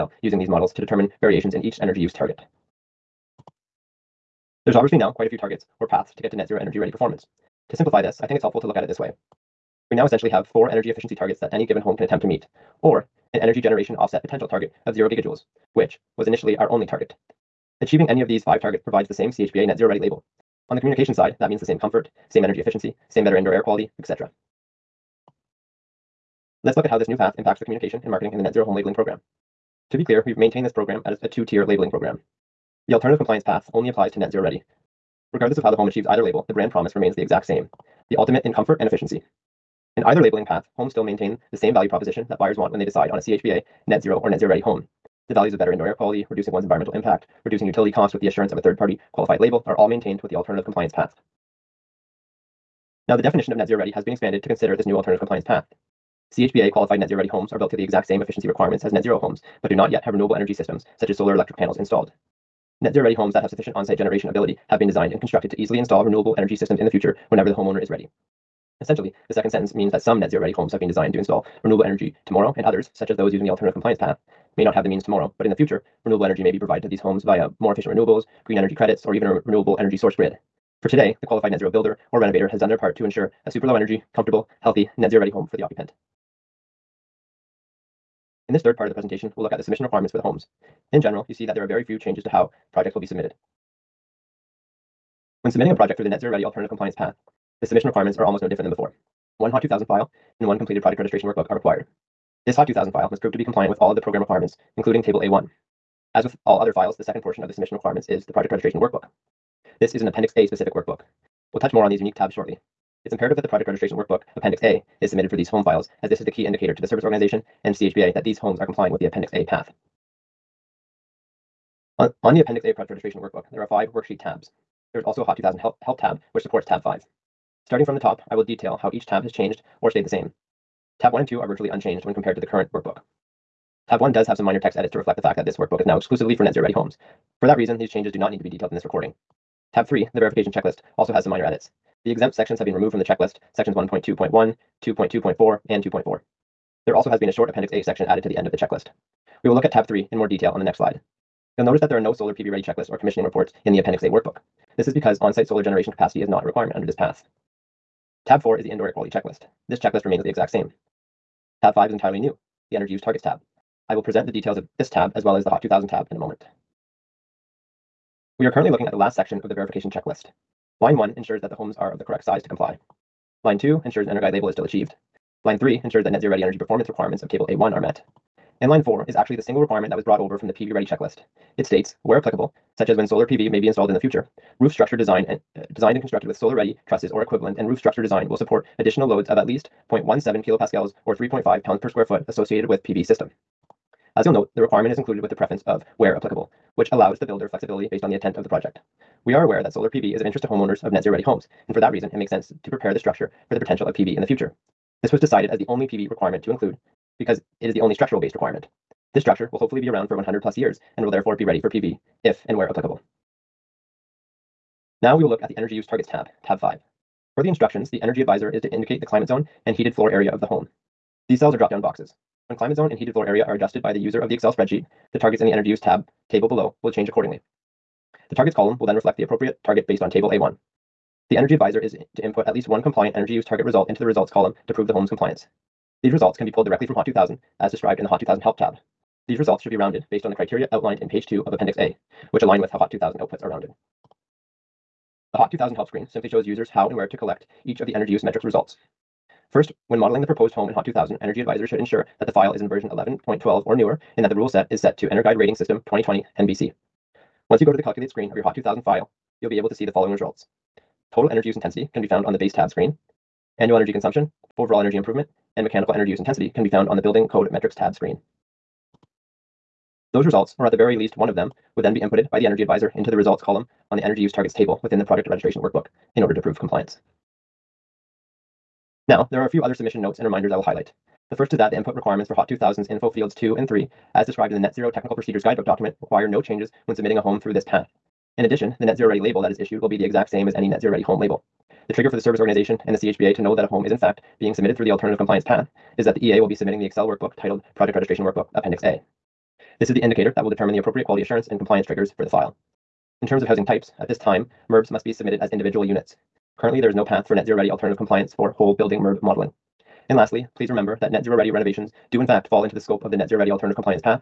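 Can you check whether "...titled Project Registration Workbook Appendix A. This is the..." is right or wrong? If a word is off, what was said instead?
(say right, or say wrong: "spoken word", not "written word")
right.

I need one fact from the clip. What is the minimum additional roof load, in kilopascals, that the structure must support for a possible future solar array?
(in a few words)
0.17 kilopascals.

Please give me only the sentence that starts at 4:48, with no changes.
In addition, the Net Zero Ready label that is issued will be the exact same as any Net Zero Ready home label.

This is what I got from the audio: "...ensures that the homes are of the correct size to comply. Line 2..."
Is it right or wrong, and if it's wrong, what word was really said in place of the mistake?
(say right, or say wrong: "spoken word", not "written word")
right.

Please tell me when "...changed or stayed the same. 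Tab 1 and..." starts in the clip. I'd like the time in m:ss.
2:09.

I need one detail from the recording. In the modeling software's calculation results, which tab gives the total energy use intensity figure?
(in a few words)
Base tab.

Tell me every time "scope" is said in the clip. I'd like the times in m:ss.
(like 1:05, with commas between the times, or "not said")
5:12.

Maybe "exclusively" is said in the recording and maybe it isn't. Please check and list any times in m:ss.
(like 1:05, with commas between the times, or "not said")
2:15.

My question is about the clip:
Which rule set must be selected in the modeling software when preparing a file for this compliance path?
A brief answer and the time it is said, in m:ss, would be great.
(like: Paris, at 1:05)
EnerGuide Rating System 2020 NBC, at 4:15.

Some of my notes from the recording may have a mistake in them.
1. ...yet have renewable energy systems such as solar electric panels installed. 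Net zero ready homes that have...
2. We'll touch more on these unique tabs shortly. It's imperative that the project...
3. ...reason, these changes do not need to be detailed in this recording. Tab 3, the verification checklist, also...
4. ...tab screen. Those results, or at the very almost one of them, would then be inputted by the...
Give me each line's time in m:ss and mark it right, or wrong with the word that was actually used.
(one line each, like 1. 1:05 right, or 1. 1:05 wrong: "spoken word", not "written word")
1. 0:59 right
2. 1:51 right
3. 2:17 right
4. 4:27 wrong: "least", not "almost".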